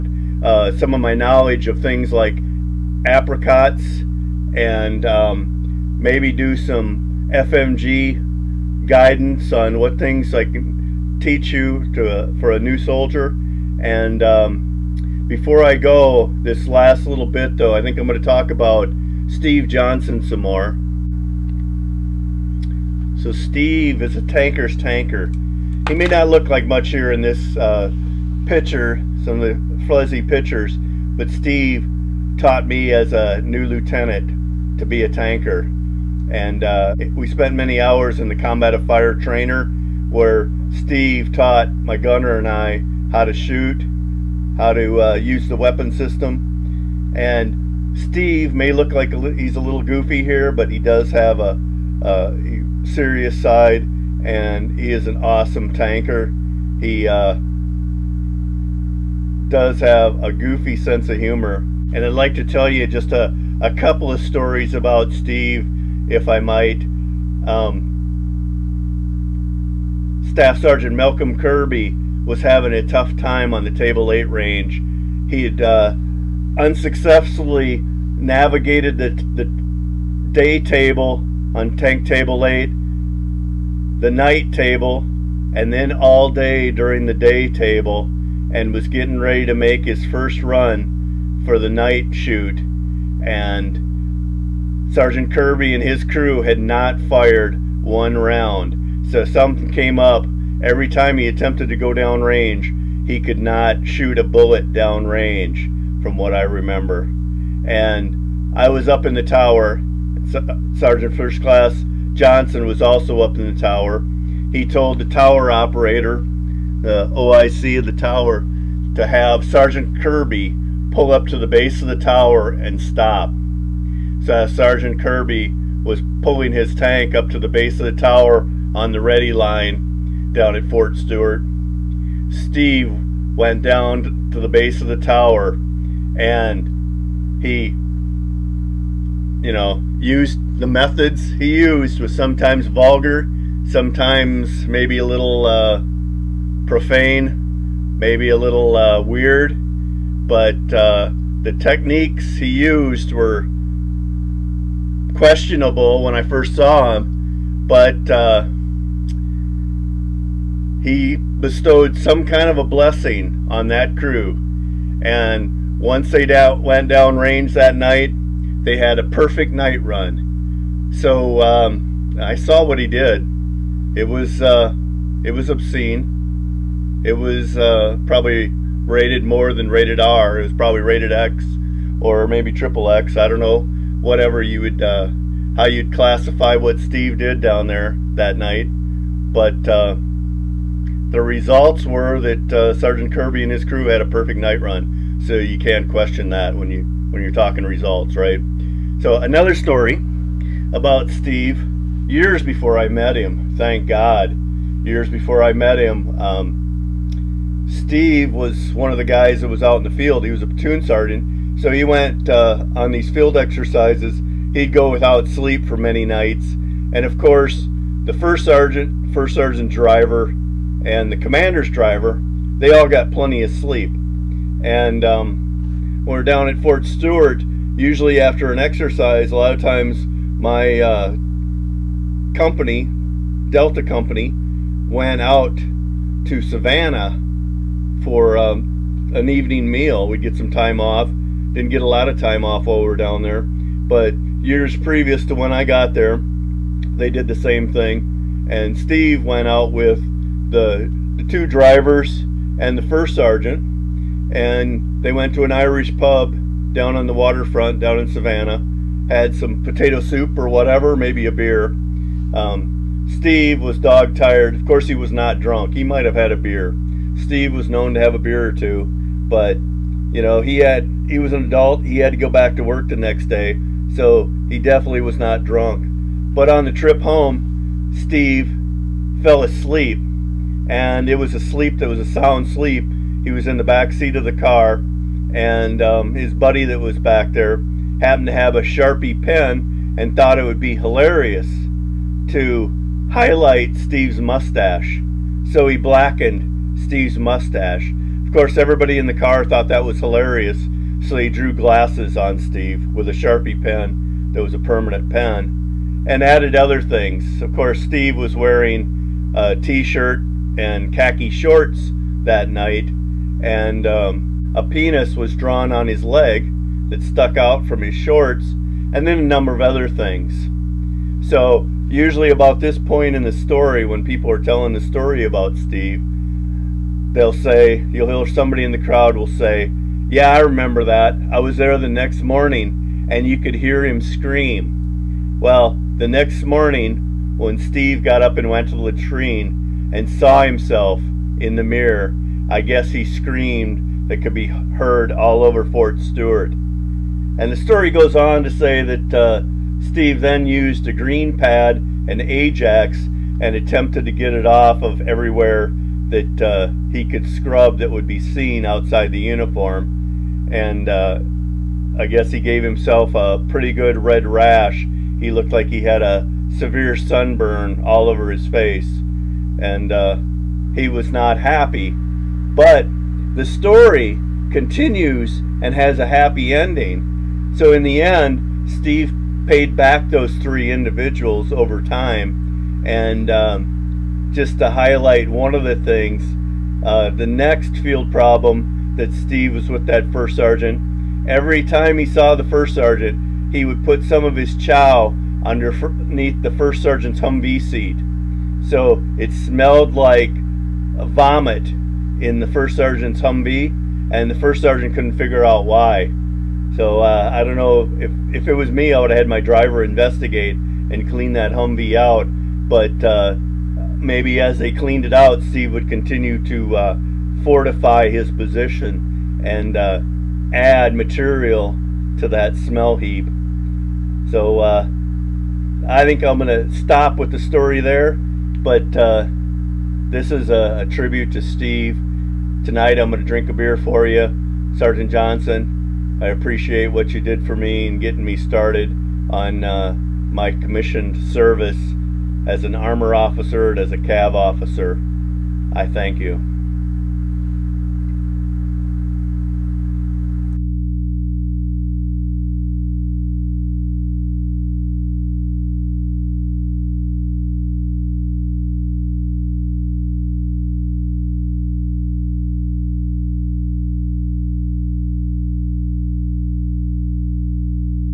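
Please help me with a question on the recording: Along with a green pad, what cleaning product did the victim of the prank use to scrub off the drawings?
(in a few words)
Ajax.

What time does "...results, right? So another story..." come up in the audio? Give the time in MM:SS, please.
03:17.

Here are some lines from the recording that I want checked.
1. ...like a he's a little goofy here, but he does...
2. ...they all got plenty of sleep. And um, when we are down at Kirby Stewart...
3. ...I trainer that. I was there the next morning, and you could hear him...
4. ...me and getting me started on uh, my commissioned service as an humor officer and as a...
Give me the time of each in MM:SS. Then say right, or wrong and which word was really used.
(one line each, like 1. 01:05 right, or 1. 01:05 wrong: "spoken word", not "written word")
1. 00:48 right
2. 03:42 wrong: "Fort", not "Kirby"
3. 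05:30 wrong: "remember", not "trainer"
4. 07:17 wrong: "armor", not "humor".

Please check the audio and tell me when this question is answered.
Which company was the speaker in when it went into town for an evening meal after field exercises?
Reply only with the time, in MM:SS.
03:53.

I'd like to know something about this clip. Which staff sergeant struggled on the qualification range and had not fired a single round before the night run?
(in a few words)
Malcolm Kirby.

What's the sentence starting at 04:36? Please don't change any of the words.
But on the trip home, Steve fell asleep, and it was a sleep that was a sound sleep.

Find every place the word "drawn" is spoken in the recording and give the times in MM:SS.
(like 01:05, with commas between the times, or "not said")
05:15.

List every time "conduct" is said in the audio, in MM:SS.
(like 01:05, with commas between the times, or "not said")
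00:38.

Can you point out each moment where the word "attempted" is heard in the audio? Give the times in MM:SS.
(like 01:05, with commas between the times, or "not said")
01:41, 05:53.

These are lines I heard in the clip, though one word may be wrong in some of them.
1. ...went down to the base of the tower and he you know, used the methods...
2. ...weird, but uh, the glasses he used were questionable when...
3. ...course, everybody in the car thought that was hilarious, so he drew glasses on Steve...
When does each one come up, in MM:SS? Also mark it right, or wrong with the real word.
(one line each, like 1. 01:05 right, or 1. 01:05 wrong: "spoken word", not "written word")
1. 02:13 right
2. 02:28 wrong: "techniques", not "glasses"
3. 04:58 right.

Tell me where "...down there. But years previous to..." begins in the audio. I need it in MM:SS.
04:02.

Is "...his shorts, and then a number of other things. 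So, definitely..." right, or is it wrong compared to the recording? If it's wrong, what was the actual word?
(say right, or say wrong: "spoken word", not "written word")
wrong: "usually", not "definitely".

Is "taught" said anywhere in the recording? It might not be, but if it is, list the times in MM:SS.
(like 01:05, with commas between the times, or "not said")
00:32, 00:41.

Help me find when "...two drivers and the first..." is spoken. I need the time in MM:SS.
04:11.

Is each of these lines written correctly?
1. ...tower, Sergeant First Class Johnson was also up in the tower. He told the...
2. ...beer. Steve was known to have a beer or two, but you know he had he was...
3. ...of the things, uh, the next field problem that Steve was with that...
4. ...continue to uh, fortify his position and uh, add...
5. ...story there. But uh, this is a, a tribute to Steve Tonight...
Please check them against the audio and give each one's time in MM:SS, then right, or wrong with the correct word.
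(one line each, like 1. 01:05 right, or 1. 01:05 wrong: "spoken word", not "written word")
1. 01:49 right
2. 04:26 right
3. 06:25 right
4. 06:55 right
5. 07:07 right.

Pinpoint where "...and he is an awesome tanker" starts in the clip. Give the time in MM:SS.
00:54.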